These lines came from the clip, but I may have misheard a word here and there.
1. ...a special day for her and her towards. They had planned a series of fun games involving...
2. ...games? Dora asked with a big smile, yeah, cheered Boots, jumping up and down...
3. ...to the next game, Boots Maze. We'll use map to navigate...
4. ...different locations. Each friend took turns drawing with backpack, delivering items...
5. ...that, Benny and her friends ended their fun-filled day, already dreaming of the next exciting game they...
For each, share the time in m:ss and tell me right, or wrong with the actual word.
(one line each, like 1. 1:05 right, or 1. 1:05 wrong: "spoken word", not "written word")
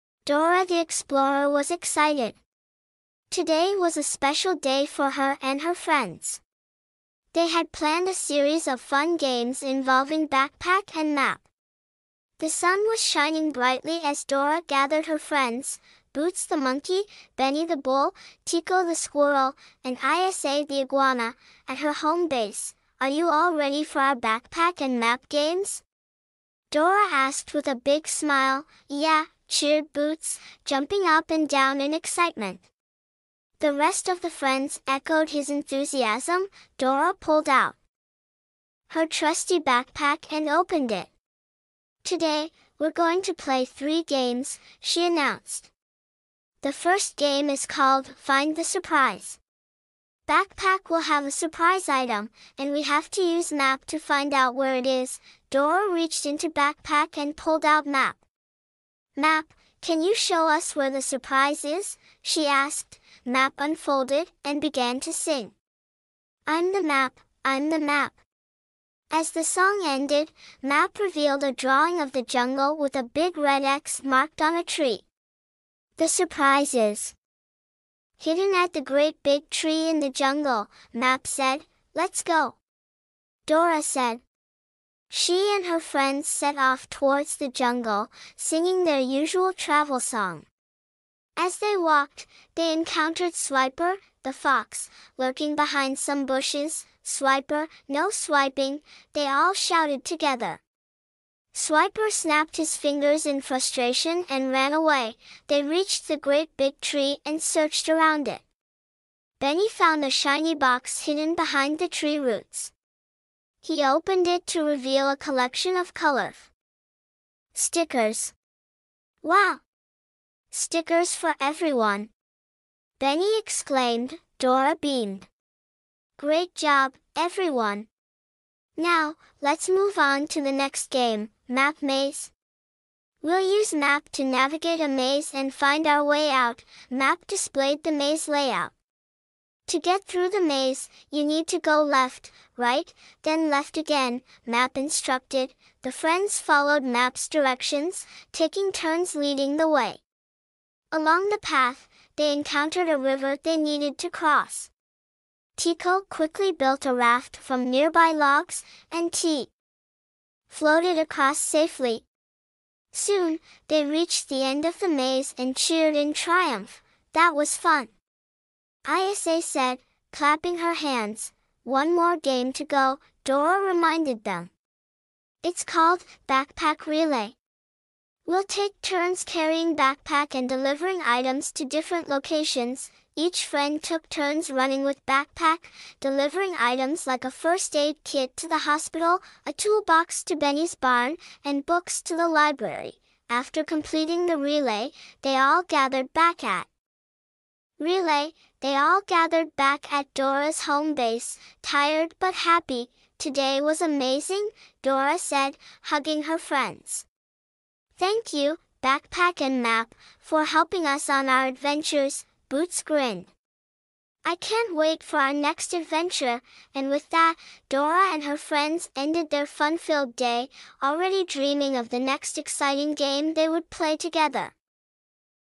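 1. 0:03 wrong: "friends", not "towards"
2. 0:25 right
3. 2:10 wrong: "Map", not "Boots"
4. 3:01 wrong: "running", not "drawing"
5. 3:37 wrong: "Dora", not "Benny".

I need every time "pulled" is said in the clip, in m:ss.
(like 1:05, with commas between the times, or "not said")
0:37, 0:57.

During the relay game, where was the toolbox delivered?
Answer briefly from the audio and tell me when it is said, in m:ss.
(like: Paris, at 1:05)
Benny's barn, at 3:10.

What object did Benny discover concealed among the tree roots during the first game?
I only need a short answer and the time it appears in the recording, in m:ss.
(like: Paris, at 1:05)
A shiny box, at 1:50.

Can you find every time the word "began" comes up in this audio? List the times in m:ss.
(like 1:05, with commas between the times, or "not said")
1:04.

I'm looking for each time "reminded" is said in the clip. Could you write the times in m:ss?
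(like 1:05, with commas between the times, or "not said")
2:53.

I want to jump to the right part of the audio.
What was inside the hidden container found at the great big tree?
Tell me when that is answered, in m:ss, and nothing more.
1:55.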